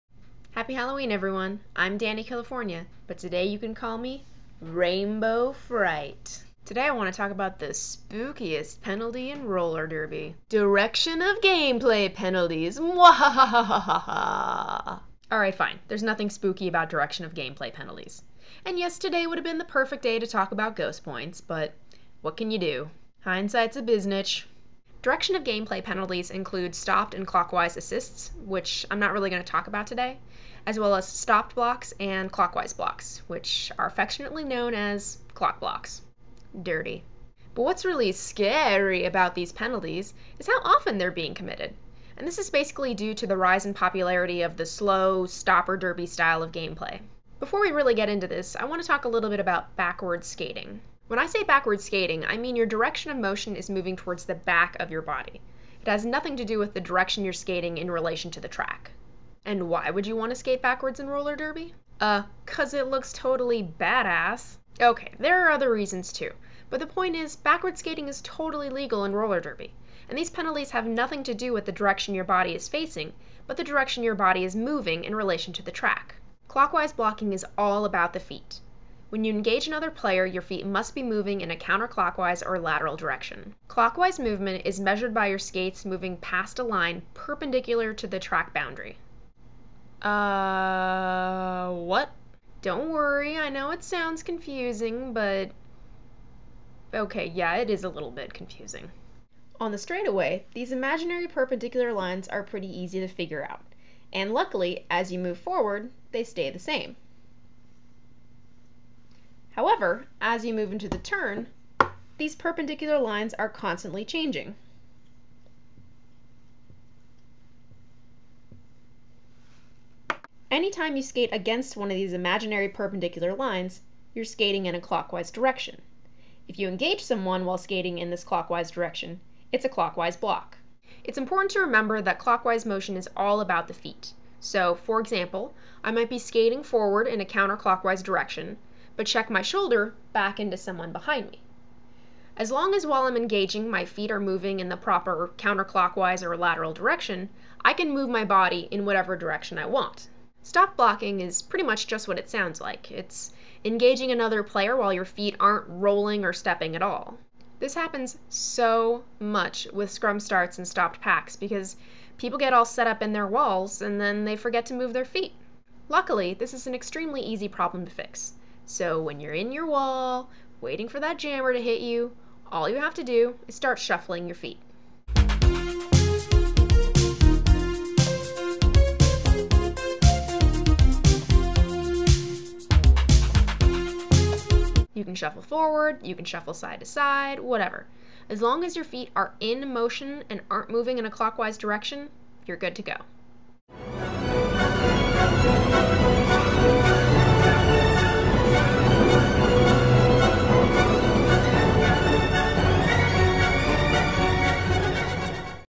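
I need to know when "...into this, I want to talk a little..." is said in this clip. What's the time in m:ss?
0:48.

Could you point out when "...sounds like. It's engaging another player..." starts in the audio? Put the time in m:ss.
2:32.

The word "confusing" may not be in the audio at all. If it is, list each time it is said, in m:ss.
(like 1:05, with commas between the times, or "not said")
1:34, 1:38.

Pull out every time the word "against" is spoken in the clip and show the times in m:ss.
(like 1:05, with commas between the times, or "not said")
2:01.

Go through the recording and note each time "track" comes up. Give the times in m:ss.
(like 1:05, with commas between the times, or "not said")
0:58, 1:15, 1:28.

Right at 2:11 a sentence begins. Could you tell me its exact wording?
It's important to remember that clockwise motion is all about the feet.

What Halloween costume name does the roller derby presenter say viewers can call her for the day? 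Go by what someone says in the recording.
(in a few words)
Rainbow Fright.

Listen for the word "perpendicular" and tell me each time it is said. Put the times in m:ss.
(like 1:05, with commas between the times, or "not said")
1:27, 1:41, 1:52, 2:02.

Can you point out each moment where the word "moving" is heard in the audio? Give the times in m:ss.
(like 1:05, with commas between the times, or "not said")
0:53, 1:14, 1:21, 1:25, 2:24, 3:10.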